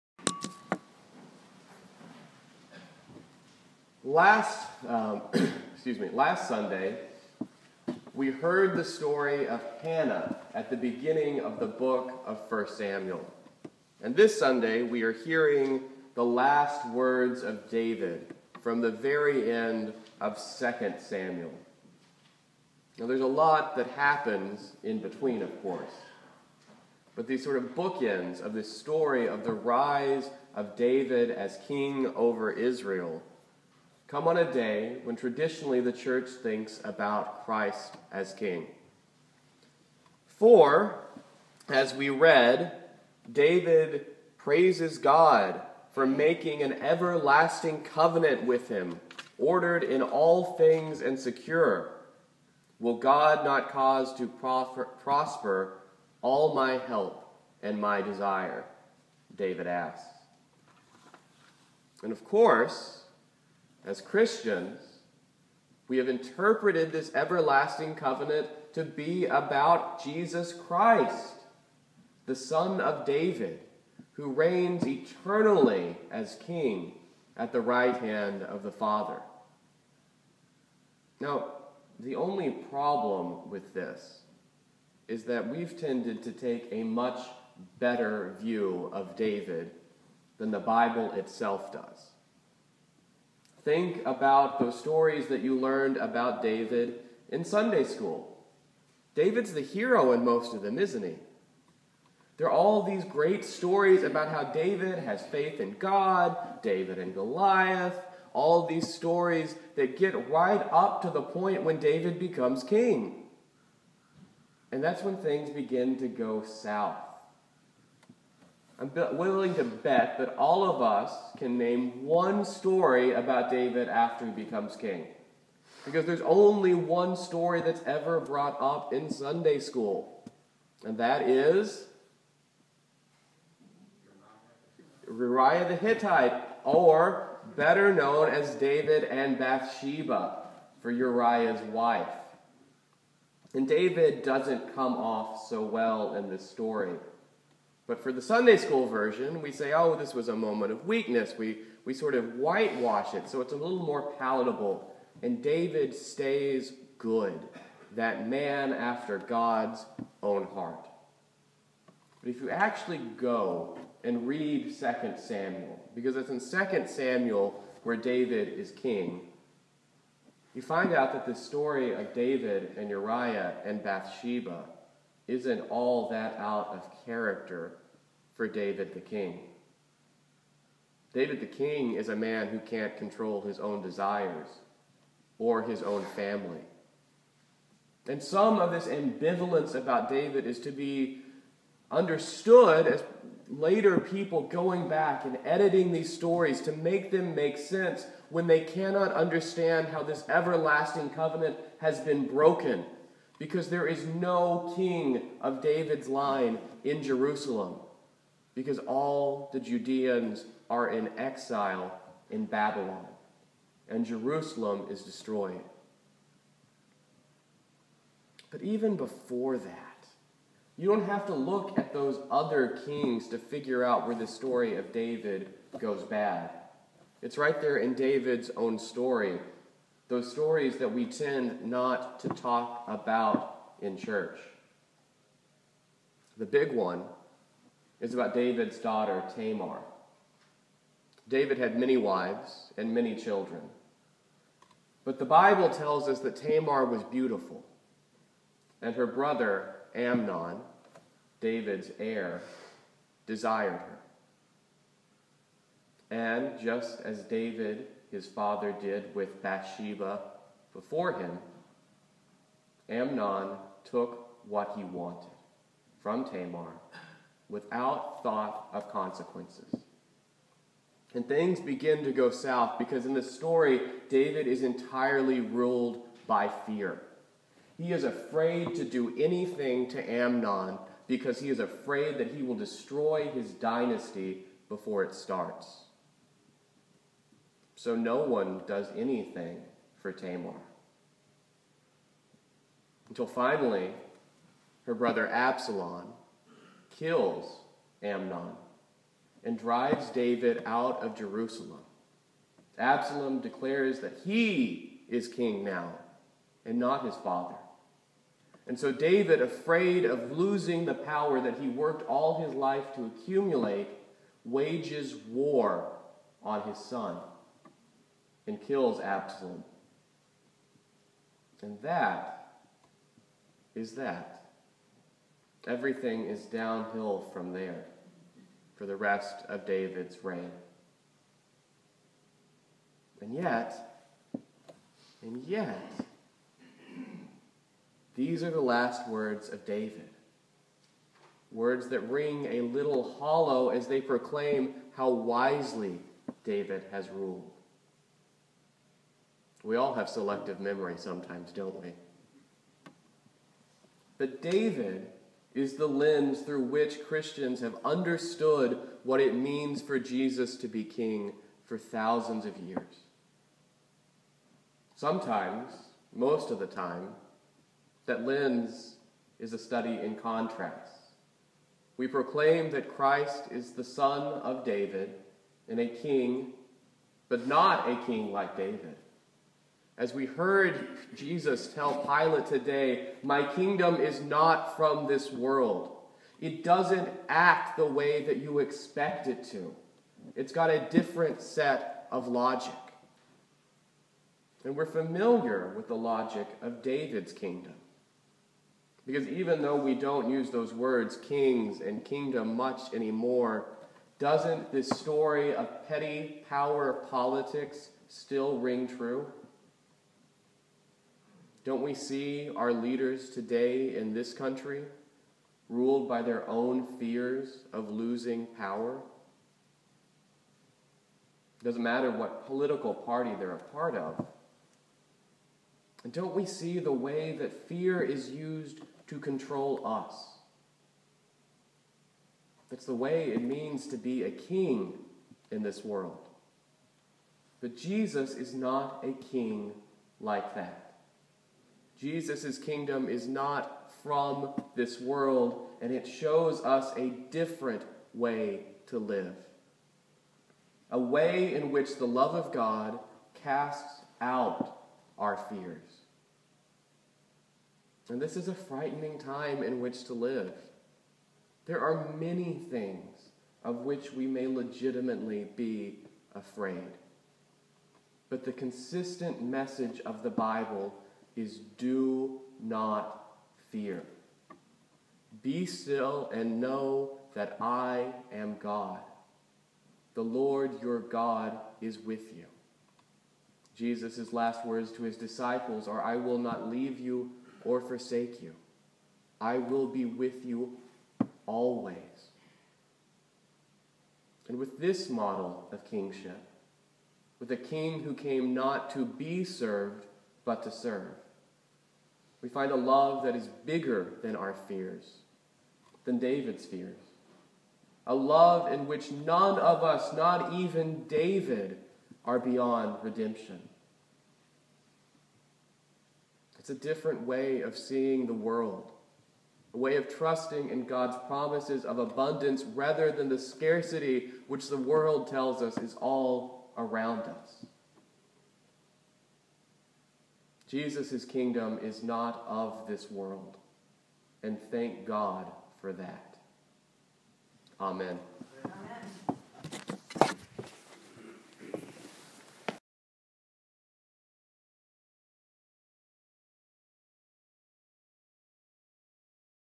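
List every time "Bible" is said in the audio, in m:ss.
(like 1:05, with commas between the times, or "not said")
1:30, 4:05, 7:50.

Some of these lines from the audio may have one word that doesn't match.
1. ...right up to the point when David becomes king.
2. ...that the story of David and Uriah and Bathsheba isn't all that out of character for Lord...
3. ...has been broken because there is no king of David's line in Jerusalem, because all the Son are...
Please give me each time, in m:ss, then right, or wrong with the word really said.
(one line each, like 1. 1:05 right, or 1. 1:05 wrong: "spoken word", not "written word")
1. 1:50 right
2. 2:51 wrong: "David", not "Lord"
3. 3:21 wrong: "Judeans", not "Son".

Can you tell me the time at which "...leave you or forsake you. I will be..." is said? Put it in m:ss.
8:06.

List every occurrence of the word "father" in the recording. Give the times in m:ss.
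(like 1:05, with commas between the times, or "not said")
1:18, 4:18, 5:07.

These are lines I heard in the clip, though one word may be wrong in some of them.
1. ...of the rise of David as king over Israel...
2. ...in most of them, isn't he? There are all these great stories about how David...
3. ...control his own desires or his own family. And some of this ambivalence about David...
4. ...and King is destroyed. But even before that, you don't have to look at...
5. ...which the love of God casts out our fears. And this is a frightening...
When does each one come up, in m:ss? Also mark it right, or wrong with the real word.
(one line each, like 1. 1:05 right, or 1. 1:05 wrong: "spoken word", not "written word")
1. 0:29 right
2. 1:40 right
3. 3:02 right
4. 3:33 wrong: "Jerusalem", not "King"
5. 7:31 right.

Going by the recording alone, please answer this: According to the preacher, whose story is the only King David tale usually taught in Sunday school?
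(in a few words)
Uriah the Hittite.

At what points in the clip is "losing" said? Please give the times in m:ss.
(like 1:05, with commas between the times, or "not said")
5:10, 6:57.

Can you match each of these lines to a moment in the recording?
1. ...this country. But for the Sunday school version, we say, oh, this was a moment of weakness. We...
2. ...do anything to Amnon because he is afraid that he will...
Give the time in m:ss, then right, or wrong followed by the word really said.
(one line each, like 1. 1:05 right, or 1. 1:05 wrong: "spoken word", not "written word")
1. 2:26 wrong: "story", not "country"
2. 4:38 right.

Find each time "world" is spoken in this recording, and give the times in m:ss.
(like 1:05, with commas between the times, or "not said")
6:25, 7:15, 7:24, 8:38, 8:44, 8:53.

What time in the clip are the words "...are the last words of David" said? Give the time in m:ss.
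5:38.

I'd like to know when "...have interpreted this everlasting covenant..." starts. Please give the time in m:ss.
1:05.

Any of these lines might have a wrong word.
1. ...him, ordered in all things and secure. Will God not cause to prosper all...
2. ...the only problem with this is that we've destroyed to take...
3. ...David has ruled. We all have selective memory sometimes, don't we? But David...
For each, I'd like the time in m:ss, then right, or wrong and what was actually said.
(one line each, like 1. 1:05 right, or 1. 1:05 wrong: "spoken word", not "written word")
1. 0:48 right
2. 1:21 wrong: "tended", not "destroyed"
3. 5:46 right.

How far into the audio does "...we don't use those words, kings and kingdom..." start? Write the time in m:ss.
6:39.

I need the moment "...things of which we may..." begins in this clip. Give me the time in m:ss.
7:42.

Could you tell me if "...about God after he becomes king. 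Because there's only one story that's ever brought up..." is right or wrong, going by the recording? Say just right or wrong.
wrong.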